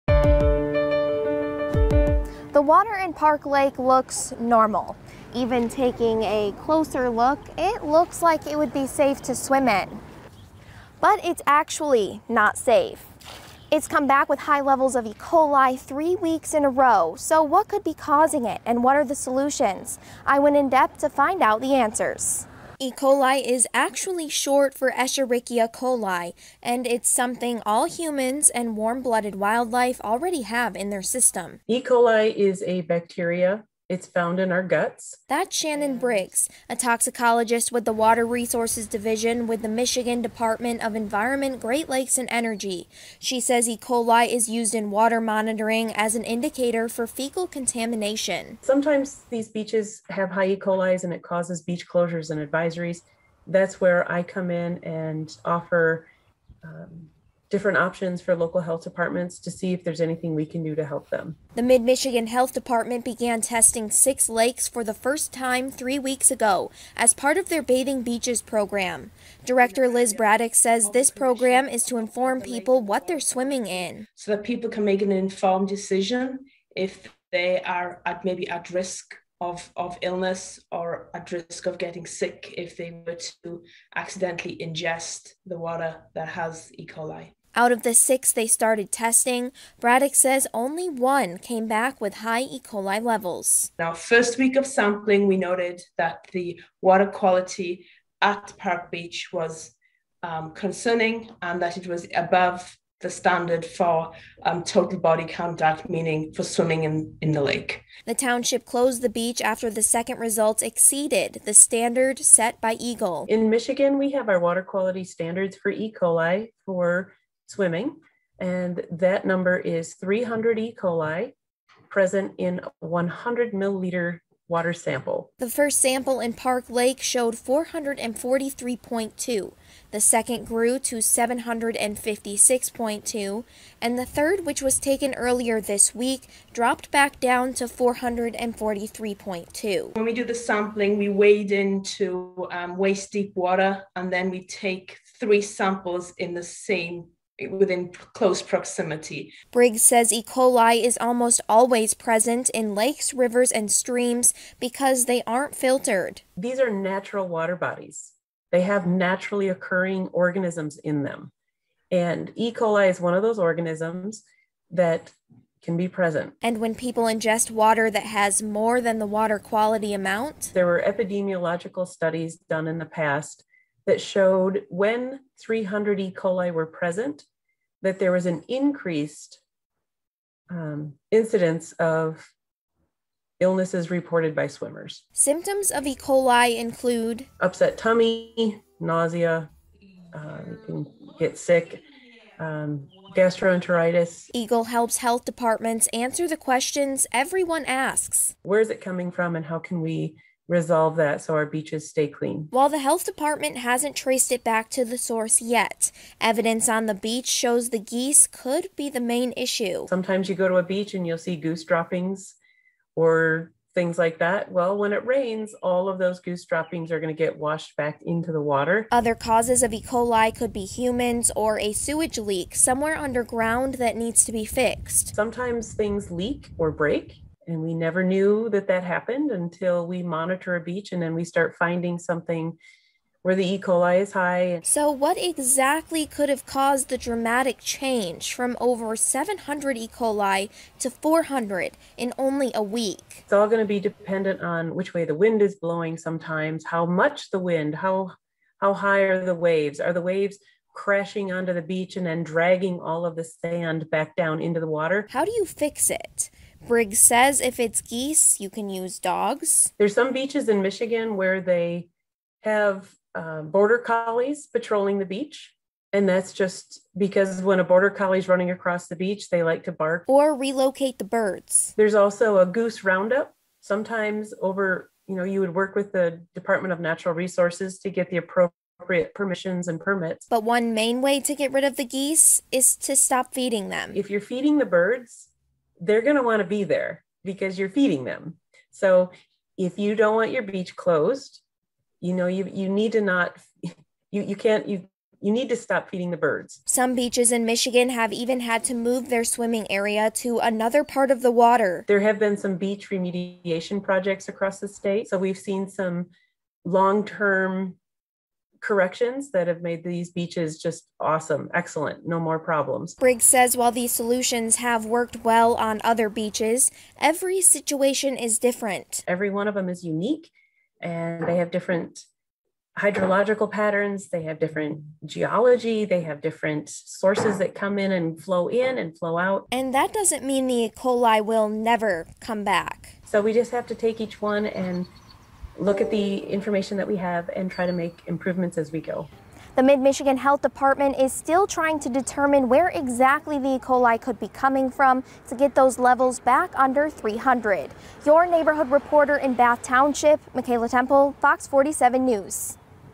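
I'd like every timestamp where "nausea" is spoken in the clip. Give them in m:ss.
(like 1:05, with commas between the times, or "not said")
3:08.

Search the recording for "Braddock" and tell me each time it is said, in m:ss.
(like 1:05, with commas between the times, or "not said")
1:10, 1:29.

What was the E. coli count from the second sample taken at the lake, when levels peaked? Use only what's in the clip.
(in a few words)
756.2.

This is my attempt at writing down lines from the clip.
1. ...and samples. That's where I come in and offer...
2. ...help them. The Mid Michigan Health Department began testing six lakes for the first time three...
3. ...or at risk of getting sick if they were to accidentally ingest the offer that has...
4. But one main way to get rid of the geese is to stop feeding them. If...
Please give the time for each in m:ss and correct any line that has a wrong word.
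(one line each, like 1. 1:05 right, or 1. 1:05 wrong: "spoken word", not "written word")
1. 0:52 wrong: "advisories", not "samples"
2. 1:00 right
3. 1:20 wrong: "water", not "offer"
4. 4:40 right.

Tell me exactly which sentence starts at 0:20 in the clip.
I went in depth to find out the answers.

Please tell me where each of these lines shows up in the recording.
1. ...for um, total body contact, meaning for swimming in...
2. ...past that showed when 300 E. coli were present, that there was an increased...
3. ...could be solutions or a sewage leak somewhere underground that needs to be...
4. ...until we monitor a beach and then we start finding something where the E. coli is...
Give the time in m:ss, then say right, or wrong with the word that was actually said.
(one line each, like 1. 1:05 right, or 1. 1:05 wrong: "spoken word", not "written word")
1. 1:43 right
2. 2:52 right
3. 3:40 wrong: "humans", not "solutions"
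4. 3:49 right.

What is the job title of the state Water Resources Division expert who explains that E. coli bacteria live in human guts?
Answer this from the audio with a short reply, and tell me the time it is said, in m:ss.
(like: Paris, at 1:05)
toxicologist, at 0:36.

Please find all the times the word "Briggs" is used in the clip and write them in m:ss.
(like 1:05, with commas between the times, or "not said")
0:35, 2:29, 4:16, 5:12.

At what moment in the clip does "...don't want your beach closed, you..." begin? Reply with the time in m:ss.
4:49.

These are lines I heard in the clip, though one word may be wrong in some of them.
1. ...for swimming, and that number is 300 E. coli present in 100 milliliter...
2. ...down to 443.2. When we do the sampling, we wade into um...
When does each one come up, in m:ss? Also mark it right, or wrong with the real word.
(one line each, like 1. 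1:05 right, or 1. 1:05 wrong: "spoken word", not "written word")
1. 1:56 right
2. 2:17 right.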